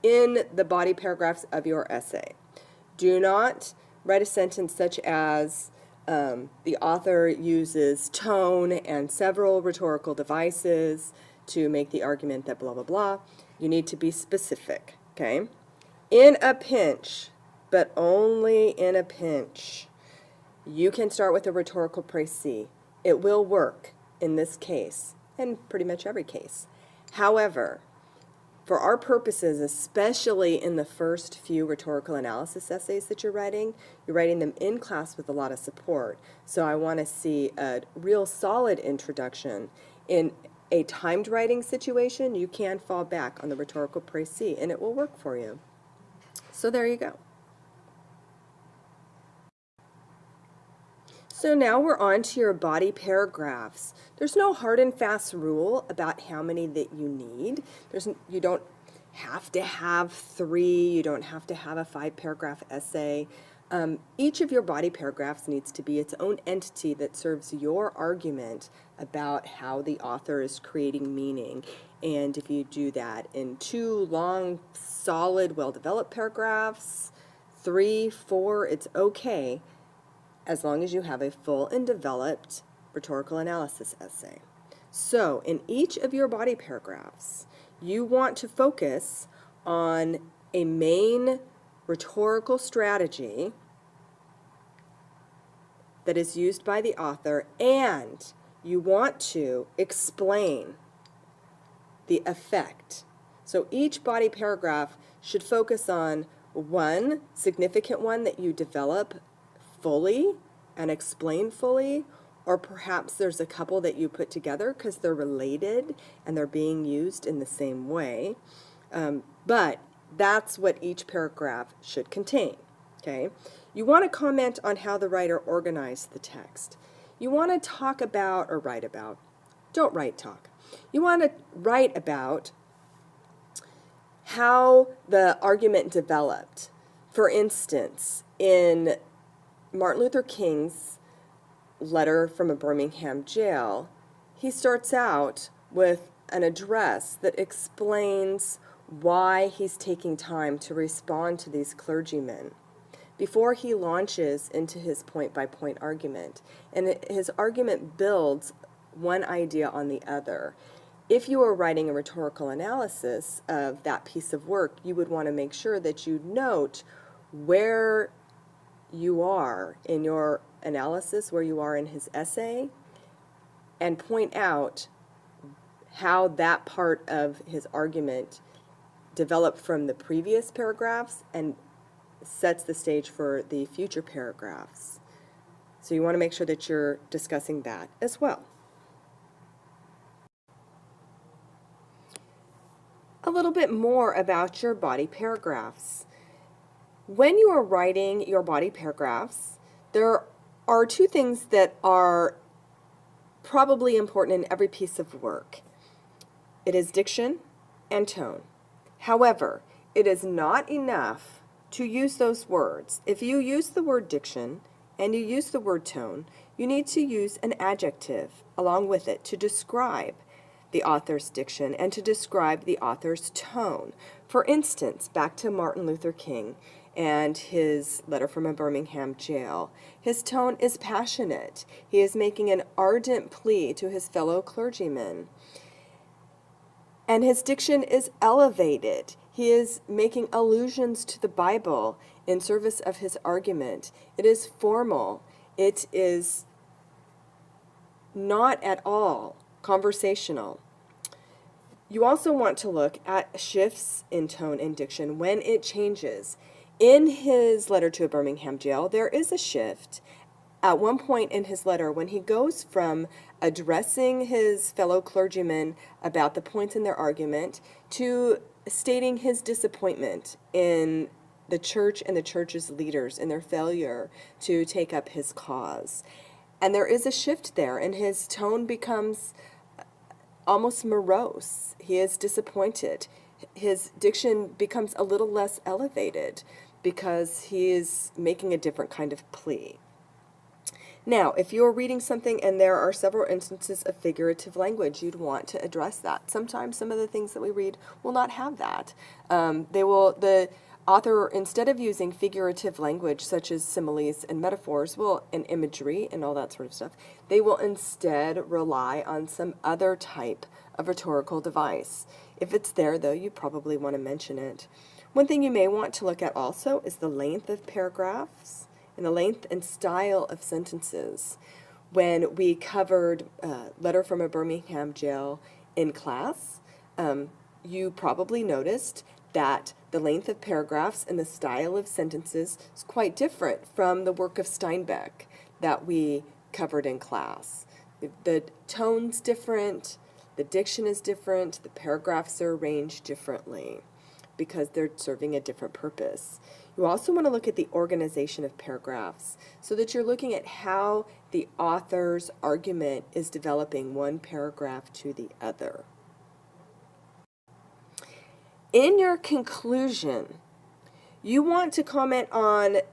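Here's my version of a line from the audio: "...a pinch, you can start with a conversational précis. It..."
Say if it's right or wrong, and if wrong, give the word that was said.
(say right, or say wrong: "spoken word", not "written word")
wrong: "rhetorical", not "conversational".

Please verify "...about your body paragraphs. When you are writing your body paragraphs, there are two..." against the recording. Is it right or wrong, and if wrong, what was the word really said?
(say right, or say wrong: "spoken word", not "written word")
right.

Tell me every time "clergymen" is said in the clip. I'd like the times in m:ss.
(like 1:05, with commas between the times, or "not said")
2:31, 3:54, 4:24.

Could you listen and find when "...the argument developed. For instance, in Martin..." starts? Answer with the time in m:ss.
2:15.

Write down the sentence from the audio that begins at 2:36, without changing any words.
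And his argument builds one idea on the other.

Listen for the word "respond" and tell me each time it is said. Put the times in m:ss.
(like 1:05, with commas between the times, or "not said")
2:30.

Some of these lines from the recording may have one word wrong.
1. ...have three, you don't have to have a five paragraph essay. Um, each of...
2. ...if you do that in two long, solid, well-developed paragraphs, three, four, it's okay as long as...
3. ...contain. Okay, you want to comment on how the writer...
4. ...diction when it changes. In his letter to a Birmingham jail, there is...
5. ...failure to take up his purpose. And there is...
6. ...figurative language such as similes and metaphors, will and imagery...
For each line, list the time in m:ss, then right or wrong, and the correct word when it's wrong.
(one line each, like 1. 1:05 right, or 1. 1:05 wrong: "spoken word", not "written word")
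1. 0:59 right
2. 1:12 right
3. 2:02 right
4. 4:14 right
5. 4:33 wrong: "cause", not "purpose"
6. 5:02 right.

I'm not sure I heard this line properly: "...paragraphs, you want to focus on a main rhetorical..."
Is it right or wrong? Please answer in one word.
right.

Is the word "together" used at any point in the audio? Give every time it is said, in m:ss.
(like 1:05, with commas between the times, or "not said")
1:54.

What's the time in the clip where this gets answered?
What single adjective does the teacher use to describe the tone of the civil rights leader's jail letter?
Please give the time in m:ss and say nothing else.
3:50.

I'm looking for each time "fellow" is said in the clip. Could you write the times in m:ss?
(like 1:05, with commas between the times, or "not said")
3:54, 4:24.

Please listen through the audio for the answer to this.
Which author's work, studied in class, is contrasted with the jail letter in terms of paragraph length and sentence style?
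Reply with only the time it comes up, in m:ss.
5:34.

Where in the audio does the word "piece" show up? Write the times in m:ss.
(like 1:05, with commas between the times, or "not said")
2:44, 3:24.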